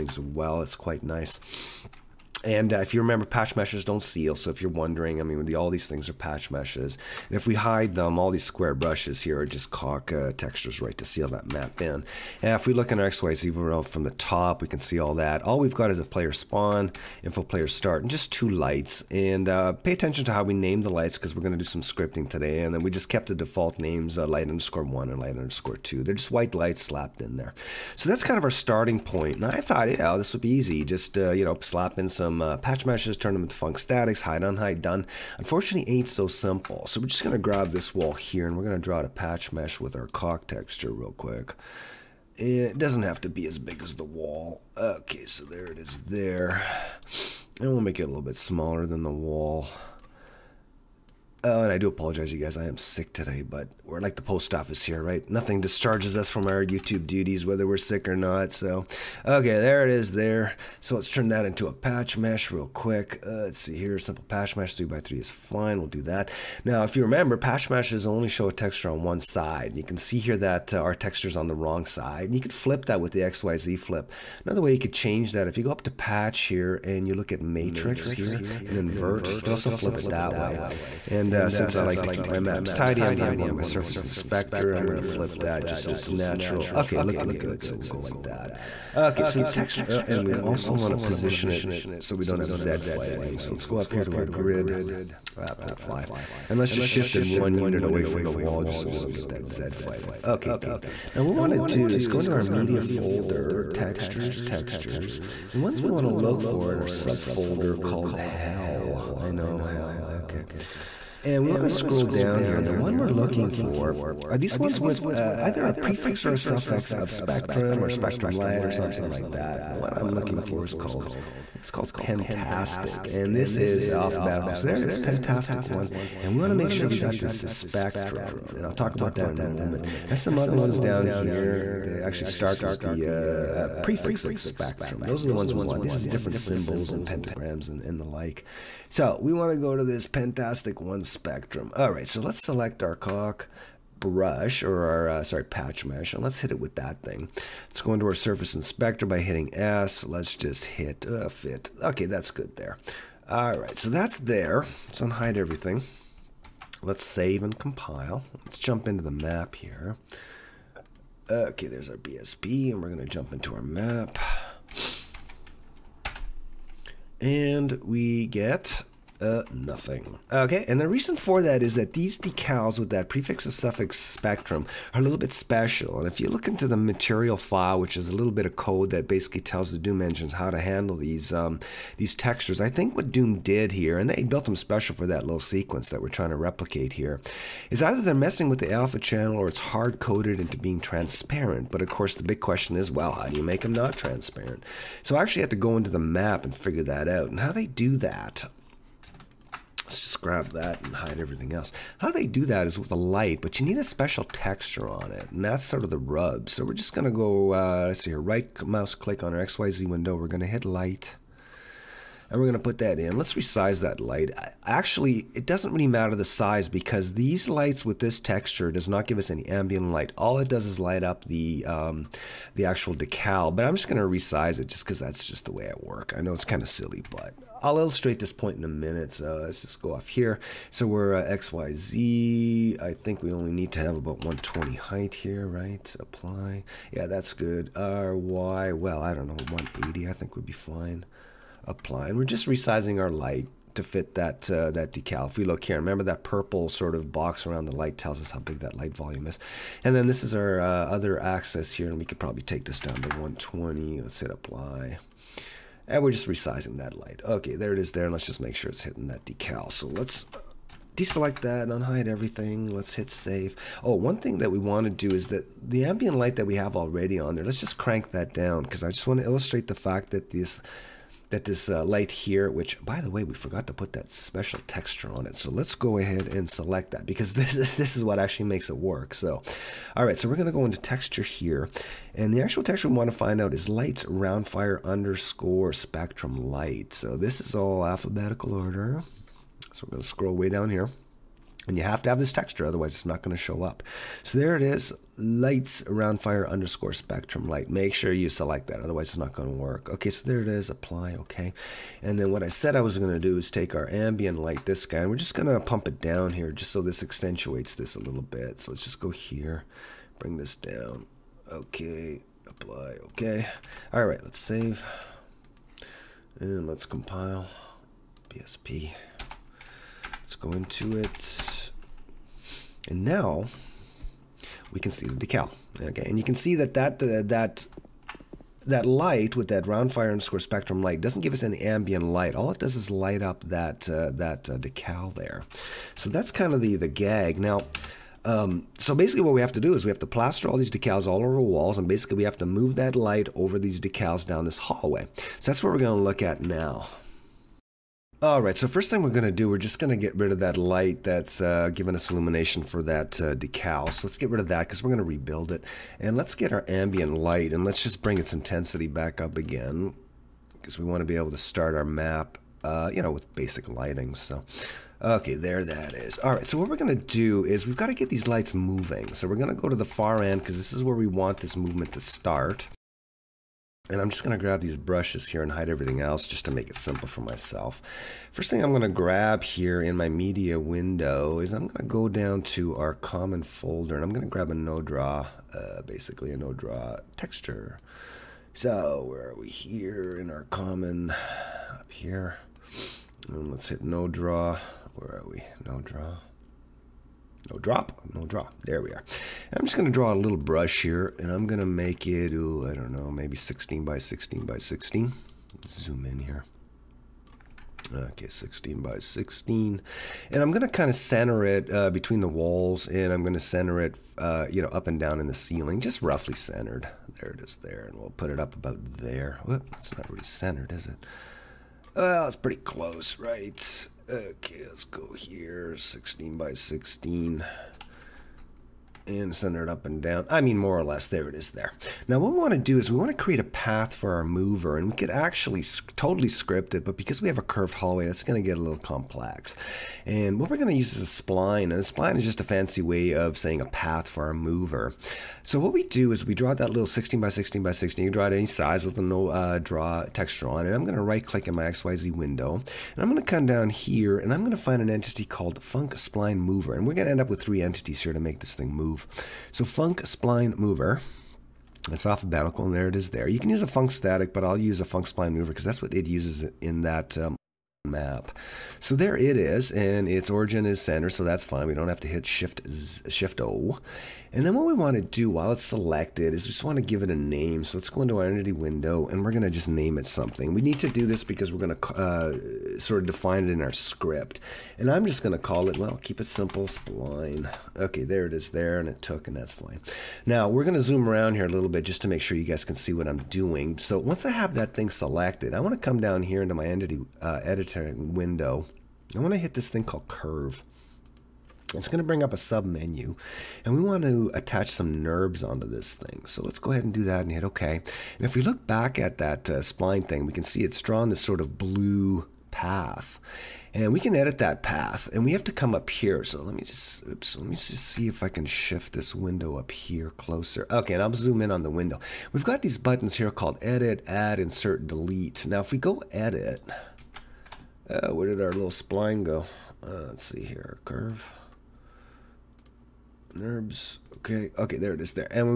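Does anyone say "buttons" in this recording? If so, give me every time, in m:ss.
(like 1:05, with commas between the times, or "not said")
8:42.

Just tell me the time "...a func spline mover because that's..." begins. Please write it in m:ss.
7:44.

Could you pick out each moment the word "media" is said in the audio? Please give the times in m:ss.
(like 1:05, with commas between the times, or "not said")
1:42, 6:20.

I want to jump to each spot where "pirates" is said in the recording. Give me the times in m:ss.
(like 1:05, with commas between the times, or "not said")
not said.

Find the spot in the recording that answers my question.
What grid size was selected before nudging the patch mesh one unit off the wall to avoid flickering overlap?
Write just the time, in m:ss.
1:35.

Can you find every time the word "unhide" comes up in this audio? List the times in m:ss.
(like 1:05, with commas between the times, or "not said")
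2:35, 4:21.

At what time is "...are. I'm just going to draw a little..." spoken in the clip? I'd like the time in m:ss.
6:38.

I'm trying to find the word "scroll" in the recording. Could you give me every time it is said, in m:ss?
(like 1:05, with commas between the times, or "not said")
1:51, 4:50.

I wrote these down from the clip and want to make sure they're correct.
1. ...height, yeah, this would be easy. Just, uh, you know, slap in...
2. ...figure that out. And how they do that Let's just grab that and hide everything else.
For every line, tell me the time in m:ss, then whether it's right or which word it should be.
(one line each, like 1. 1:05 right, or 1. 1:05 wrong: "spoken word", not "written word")
1. 0:29 wrong: "thought", not "height"
2. 3:16 right.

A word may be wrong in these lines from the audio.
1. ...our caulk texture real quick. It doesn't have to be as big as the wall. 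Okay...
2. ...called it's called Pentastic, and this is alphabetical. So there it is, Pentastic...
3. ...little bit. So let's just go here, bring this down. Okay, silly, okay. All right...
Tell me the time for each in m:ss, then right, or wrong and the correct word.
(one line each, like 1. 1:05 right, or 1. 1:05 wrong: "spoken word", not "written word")
1. 0:39 right
2. 2:00 right
3. 5:08 wrong: "apply", not "silly".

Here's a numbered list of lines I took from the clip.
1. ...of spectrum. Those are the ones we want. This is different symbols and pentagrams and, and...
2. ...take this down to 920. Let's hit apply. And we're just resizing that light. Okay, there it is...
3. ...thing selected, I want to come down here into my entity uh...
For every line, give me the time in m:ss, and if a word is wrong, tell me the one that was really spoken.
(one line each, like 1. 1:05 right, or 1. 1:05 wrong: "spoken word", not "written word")
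1. 2:14 right
2. 4:12 wrong: "120", not "920"
3. 8:14 right.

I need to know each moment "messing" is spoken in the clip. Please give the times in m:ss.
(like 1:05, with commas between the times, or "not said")
3:08.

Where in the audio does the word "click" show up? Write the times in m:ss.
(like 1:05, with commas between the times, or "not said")
3:28, 7:31.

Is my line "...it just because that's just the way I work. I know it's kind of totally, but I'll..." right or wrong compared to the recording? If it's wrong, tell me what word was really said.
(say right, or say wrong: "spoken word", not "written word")
wrong: "silly", not "totally".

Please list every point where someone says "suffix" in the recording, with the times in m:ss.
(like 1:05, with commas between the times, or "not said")
1:56, 2:53.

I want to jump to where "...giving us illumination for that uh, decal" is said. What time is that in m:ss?
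5:51.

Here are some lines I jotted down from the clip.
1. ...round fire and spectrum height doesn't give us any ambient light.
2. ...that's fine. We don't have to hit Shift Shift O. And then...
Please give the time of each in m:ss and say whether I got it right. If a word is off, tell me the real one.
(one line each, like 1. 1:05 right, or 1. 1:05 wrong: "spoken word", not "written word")
1. 5:29 wrong: "light", not "height"
2. 7:51 right.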